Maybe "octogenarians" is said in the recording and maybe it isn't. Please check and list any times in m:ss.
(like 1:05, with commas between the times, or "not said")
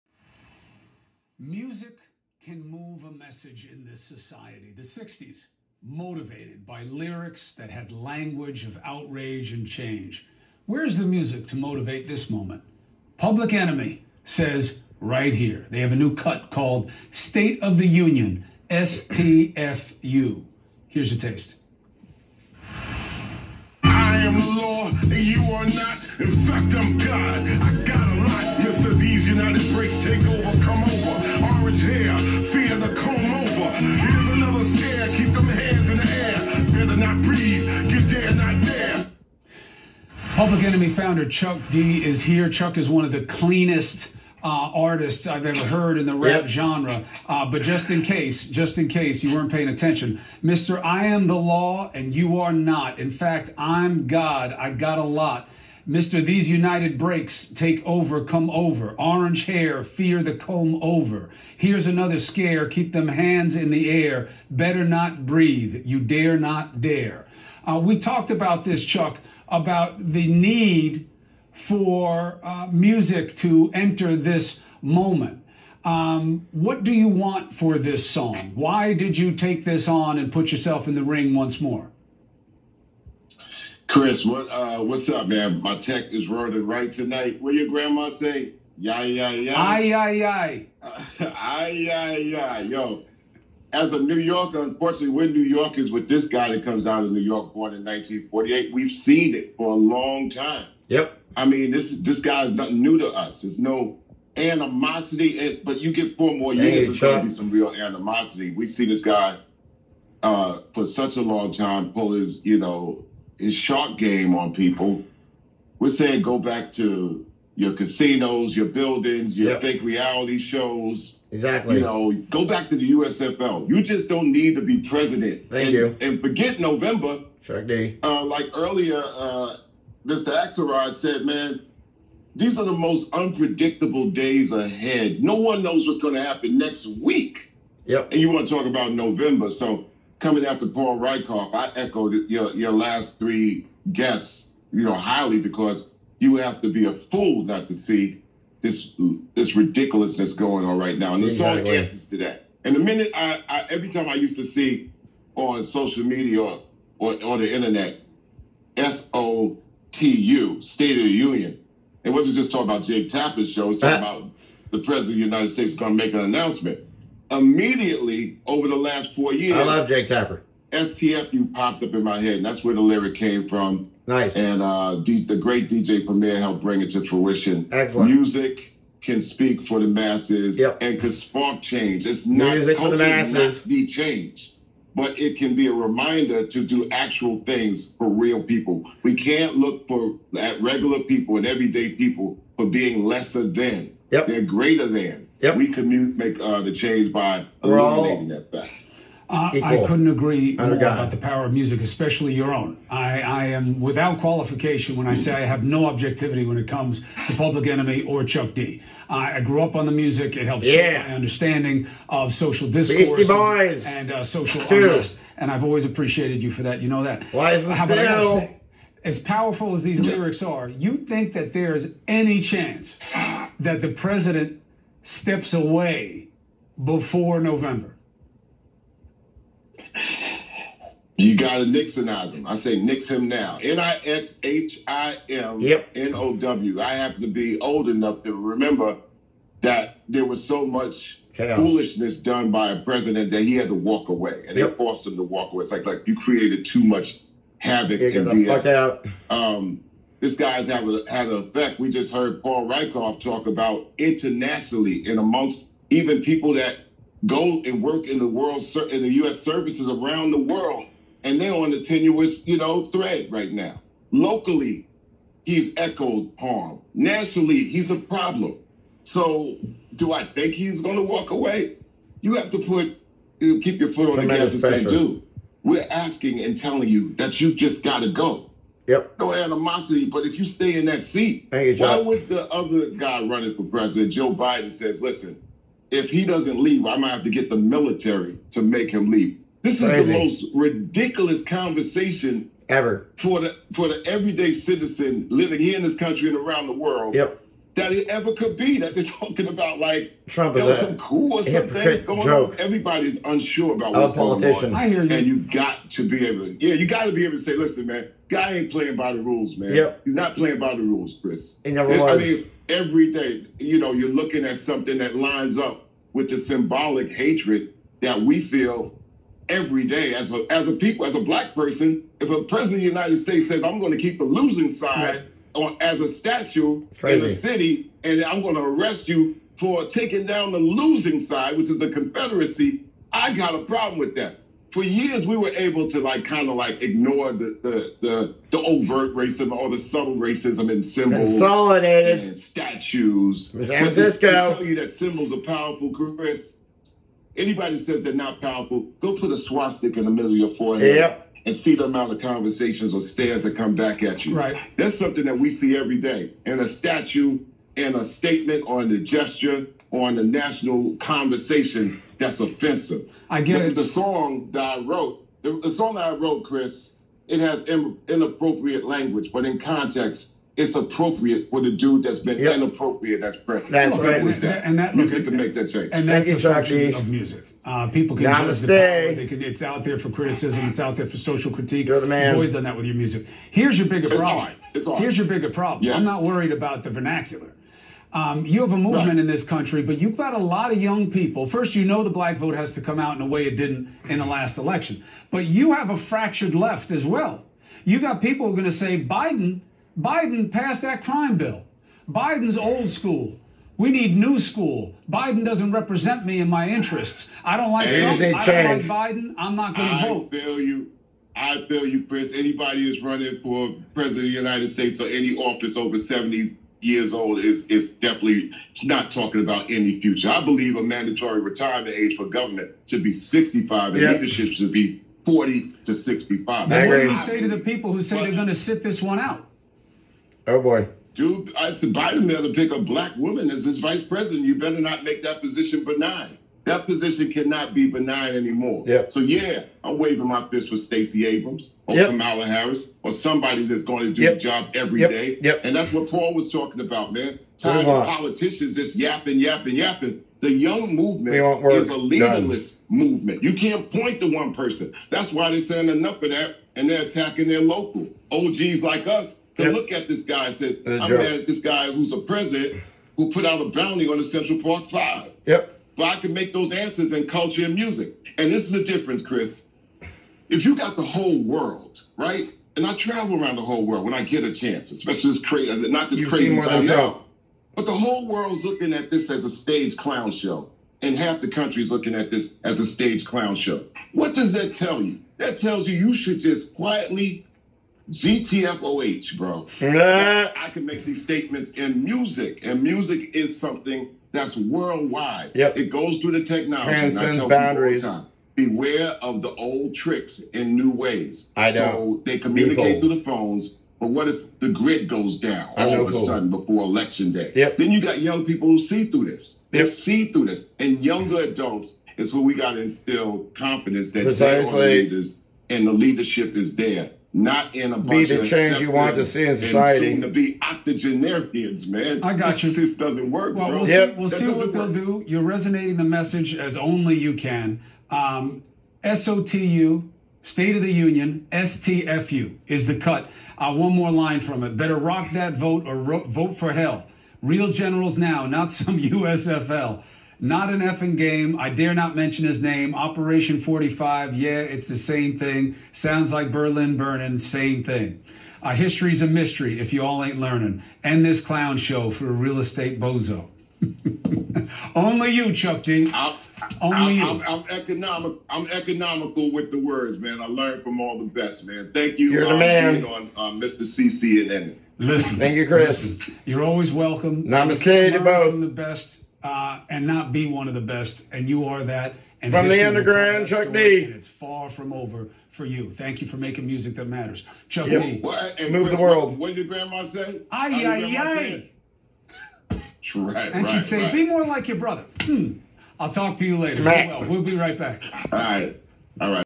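8:40.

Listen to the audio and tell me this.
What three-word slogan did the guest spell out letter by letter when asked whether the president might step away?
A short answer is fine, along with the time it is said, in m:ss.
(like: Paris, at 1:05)
Nix him now, at 3:52.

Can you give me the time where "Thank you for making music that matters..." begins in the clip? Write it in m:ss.
9:35.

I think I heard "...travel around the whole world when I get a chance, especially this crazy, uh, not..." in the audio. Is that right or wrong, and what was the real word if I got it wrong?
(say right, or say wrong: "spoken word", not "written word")
right.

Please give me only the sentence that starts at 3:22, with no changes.
I, I am without qualification when I mm.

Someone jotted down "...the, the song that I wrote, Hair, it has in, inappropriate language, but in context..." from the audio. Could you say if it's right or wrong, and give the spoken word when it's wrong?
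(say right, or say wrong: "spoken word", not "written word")
wrong: "Chris", not "Hair".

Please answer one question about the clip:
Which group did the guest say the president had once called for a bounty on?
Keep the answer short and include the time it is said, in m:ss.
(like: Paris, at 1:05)
The Central Park Five, at 7:44.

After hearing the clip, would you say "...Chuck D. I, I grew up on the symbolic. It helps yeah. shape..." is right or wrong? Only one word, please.
wrong.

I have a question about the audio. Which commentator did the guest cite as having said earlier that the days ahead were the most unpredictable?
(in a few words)
Axelrod.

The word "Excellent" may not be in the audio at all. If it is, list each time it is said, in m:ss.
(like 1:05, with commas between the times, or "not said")
2:57.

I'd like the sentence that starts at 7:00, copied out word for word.
I believe a mandatory retirement age for government should be 65 and yep.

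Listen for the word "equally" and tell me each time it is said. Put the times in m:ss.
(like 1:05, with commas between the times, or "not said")
not said.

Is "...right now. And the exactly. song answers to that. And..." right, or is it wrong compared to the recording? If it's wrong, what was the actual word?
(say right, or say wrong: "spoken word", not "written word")
right.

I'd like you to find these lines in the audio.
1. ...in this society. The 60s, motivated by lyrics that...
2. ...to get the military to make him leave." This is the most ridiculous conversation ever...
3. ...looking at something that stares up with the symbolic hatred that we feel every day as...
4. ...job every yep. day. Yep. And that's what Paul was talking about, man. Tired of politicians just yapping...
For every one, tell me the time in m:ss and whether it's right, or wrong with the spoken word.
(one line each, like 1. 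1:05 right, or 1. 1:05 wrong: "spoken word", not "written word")
1. 0:03 right
2. 4:47 right
3. 5:14 wrong: "lines", not "stares"
4. 7:24 right.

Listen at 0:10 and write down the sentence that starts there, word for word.
Where's the music to motivate this moment?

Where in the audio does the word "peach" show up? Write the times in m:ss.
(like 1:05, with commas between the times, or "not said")
not said.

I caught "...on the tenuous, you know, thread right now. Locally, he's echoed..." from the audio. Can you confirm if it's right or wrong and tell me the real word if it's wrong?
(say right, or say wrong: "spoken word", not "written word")
right.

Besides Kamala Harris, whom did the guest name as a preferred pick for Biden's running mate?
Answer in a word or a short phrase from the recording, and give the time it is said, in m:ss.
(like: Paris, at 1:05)
Stacey Abrams, at 7:20.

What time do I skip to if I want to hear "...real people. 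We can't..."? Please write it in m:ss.
3:08.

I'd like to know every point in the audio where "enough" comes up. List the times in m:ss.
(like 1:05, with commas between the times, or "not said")
3:57, 7:35.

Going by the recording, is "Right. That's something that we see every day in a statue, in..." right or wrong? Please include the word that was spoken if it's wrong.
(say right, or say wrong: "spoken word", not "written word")
right.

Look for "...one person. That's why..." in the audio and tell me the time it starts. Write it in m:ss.
7:34.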